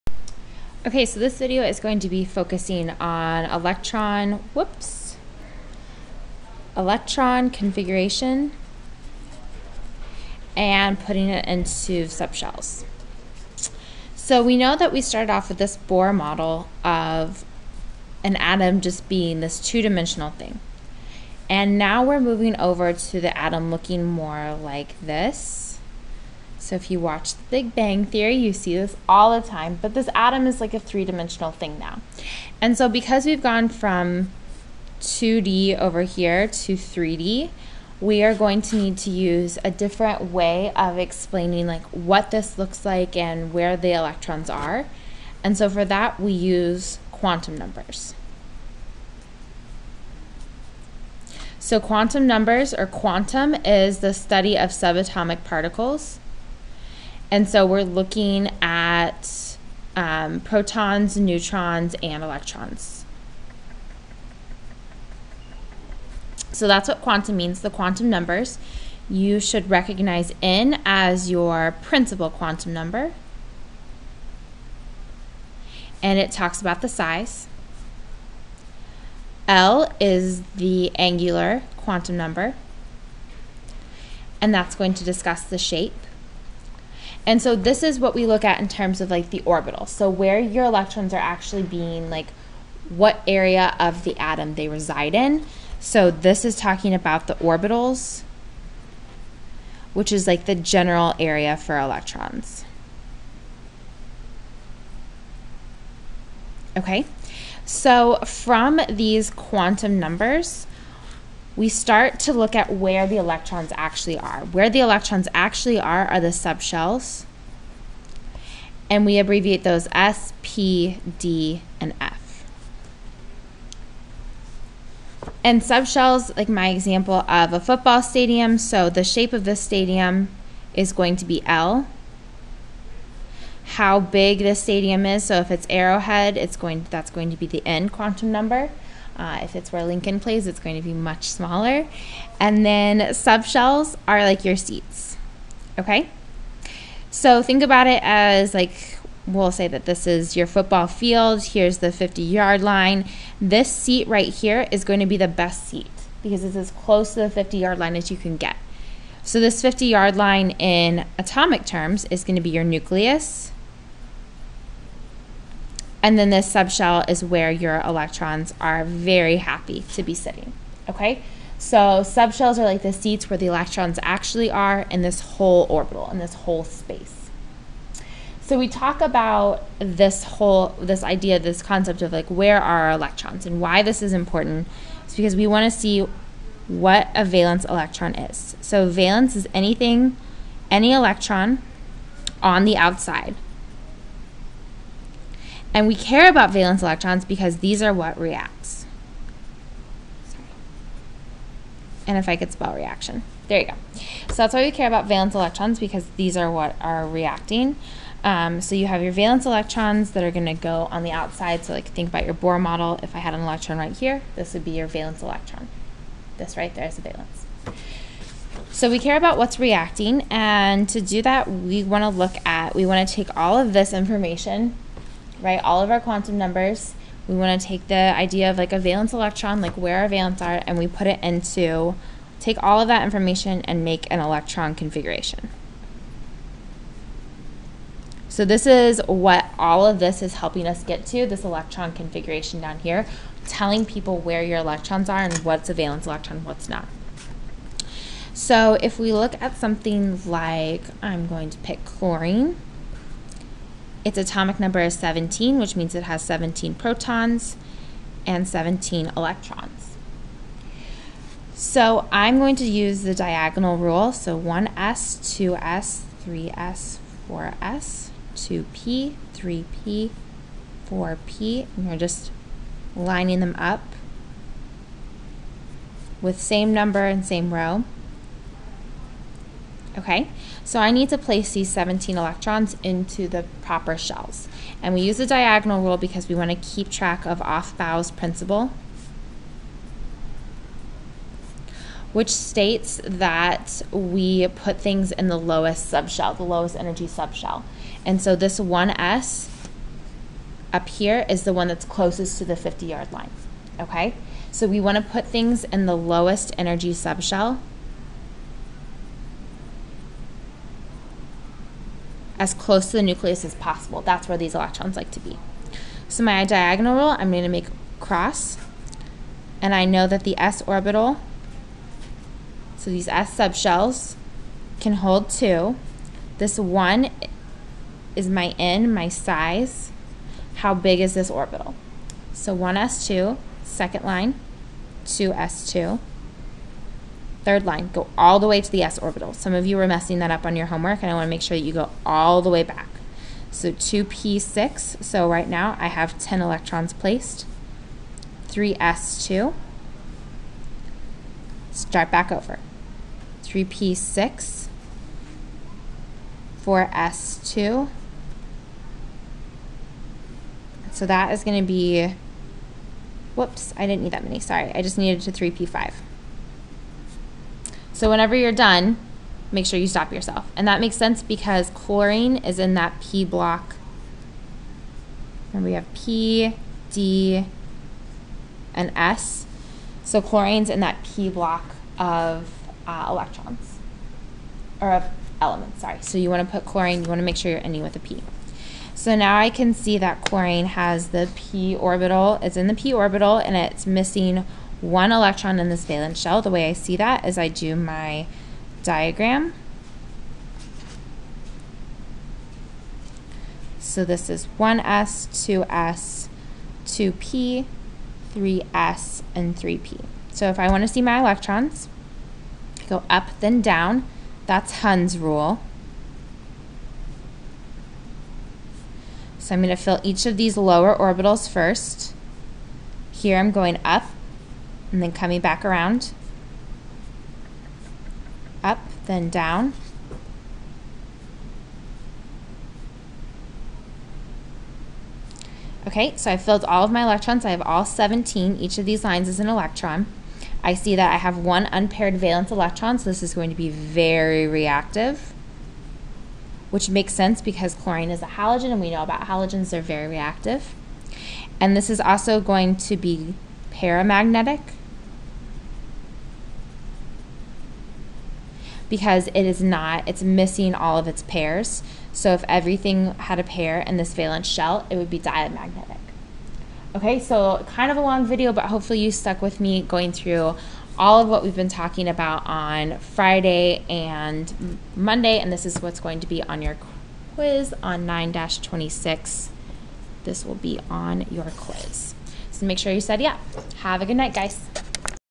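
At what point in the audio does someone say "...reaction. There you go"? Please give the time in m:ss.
3:22.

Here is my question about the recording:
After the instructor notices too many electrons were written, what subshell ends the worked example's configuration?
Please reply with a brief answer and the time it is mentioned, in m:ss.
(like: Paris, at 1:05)
3p5, at 6:05.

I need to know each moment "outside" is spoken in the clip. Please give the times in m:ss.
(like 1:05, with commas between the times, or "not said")
3:12, 3:31.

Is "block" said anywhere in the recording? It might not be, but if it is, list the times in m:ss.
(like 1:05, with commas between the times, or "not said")
6:13, 6:21.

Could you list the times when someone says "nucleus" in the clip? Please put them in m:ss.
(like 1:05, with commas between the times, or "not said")
2:42, 5:13.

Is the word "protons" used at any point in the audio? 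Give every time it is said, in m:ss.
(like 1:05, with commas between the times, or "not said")
1:00, 4:16.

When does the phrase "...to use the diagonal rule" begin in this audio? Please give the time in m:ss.
4:22.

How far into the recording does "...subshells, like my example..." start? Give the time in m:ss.
2:05.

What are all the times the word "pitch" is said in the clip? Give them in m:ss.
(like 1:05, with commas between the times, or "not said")
not said.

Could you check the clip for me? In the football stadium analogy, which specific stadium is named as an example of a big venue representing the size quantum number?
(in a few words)
Arrowhead.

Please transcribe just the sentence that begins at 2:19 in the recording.
Uh, if it's where Lincoln plays, it's going to be much smaller.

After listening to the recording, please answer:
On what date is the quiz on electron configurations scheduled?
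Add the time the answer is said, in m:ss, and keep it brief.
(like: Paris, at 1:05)
9-26, at 7:58.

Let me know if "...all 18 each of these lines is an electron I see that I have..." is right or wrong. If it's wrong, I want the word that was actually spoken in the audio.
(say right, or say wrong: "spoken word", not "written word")
wrong: "17", not "18".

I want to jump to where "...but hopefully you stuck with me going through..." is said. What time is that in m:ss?
7:48.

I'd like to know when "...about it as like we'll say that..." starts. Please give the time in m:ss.
2:27.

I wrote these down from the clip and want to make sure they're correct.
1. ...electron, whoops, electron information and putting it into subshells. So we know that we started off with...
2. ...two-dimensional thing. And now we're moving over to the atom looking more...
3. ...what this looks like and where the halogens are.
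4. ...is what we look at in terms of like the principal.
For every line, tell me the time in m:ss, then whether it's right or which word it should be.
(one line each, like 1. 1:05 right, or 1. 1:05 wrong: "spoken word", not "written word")
1. 0:03 wrong: "configuration", not "information"
2. 0:19 right
3. 0:41 wrong: "electrons", not "halogens"
4. 1:27 wrong: "orbital", not "principal".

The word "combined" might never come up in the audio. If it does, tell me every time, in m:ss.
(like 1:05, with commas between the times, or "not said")
not said.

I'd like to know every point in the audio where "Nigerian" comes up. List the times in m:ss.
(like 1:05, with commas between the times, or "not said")
not said.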